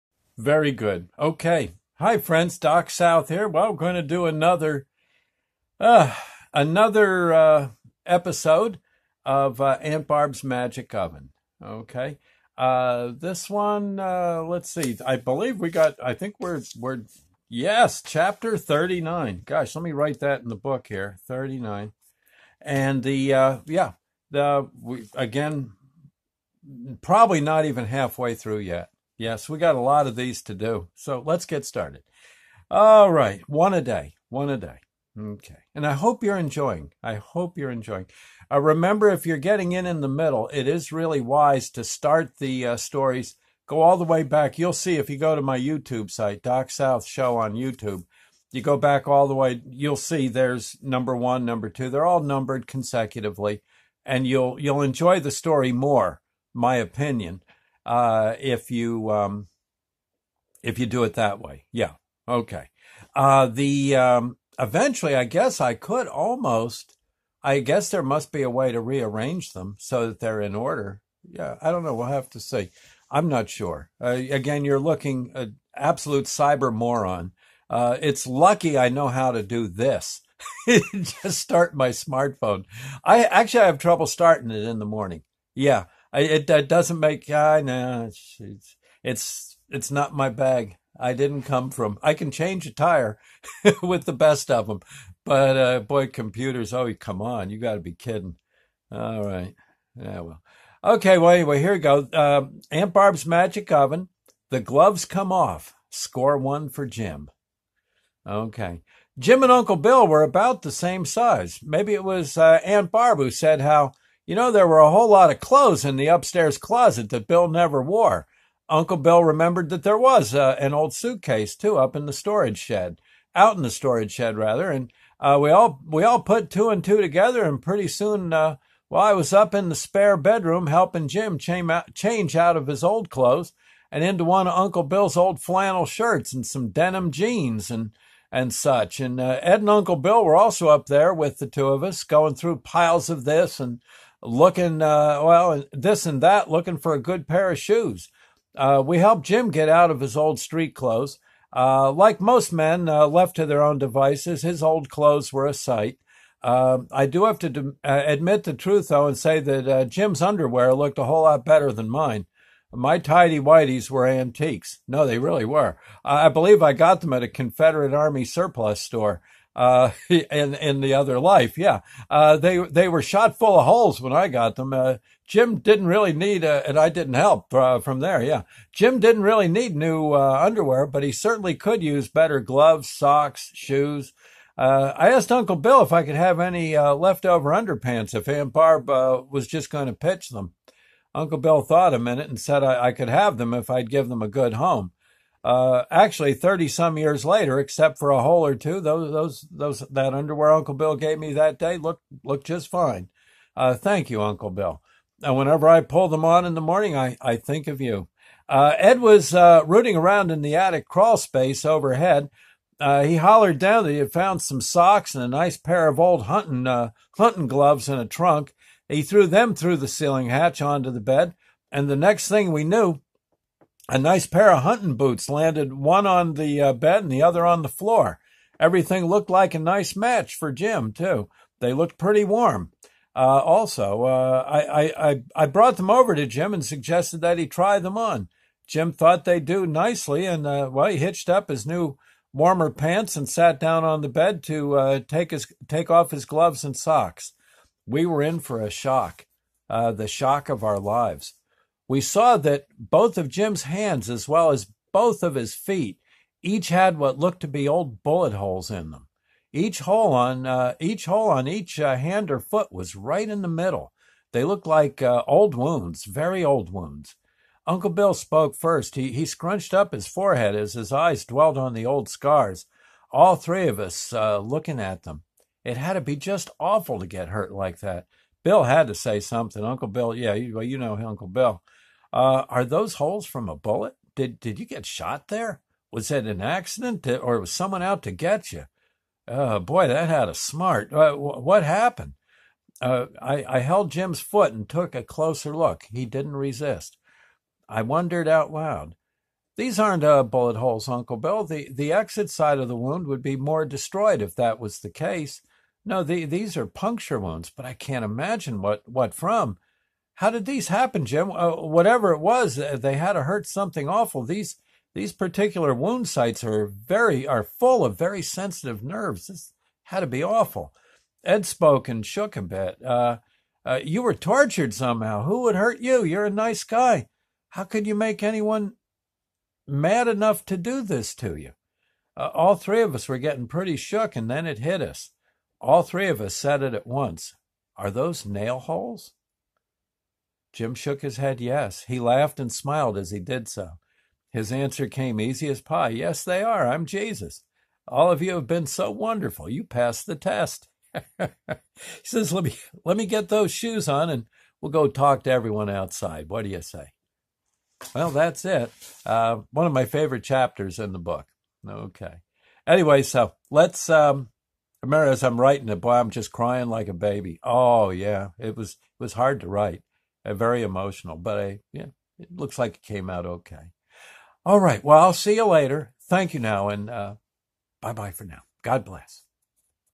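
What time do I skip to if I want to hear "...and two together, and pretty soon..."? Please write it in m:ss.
2:06.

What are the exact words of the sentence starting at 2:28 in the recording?
Uh, we helped Jim get out of his old street clothes.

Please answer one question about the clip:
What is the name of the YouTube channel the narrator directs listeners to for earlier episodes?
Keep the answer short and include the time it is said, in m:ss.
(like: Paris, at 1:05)
Doc South Show, at 0:46.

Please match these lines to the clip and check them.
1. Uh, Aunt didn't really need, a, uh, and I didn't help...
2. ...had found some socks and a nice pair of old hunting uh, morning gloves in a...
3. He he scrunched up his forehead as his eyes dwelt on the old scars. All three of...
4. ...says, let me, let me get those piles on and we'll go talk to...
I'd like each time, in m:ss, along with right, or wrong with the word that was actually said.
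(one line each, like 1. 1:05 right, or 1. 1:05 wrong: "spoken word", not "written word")
1. 2:54 wrong: "Jim", not "Aunt"
2. 3:33 wrong: "hunting", not "morning"
3. 4:28 right
4. 5:52 wrong: "shoes", not "piles".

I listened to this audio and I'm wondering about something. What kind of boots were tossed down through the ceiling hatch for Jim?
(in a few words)
hunting boots.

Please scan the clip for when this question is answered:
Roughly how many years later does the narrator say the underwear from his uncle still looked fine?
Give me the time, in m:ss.
3:16.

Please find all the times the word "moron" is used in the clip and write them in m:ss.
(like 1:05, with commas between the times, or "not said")
1:16.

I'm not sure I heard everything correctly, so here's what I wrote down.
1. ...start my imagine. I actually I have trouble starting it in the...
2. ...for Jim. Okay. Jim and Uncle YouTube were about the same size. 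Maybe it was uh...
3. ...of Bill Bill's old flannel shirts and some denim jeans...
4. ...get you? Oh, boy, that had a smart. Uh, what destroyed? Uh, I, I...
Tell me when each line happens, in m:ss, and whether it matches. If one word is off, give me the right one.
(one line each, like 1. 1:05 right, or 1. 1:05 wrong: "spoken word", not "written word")
1. 1:21 wrong: "smartphone", not "imagine"
2. 1:46 wrong: "Bill", not "YouTube"
3. 2:14 wrong: "Uncle", not "Bill"
4. 4:48 wrong: "happened", not "destroyed".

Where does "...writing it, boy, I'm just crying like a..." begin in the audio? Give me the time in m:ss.
6:05.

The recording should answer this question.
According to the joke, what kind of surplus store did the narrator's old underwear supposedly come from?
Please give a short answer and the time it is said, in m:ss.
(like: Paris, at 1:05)
Confederate Army surplus store, at 2:47.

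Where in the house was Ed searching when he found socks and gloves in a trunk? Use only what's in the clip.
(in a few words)
attic crawl space.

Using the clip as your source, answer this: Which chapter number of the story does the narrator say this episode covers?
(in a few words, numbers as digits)
39.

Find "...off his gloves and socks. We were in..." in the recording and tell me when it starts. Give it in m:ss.
4:05.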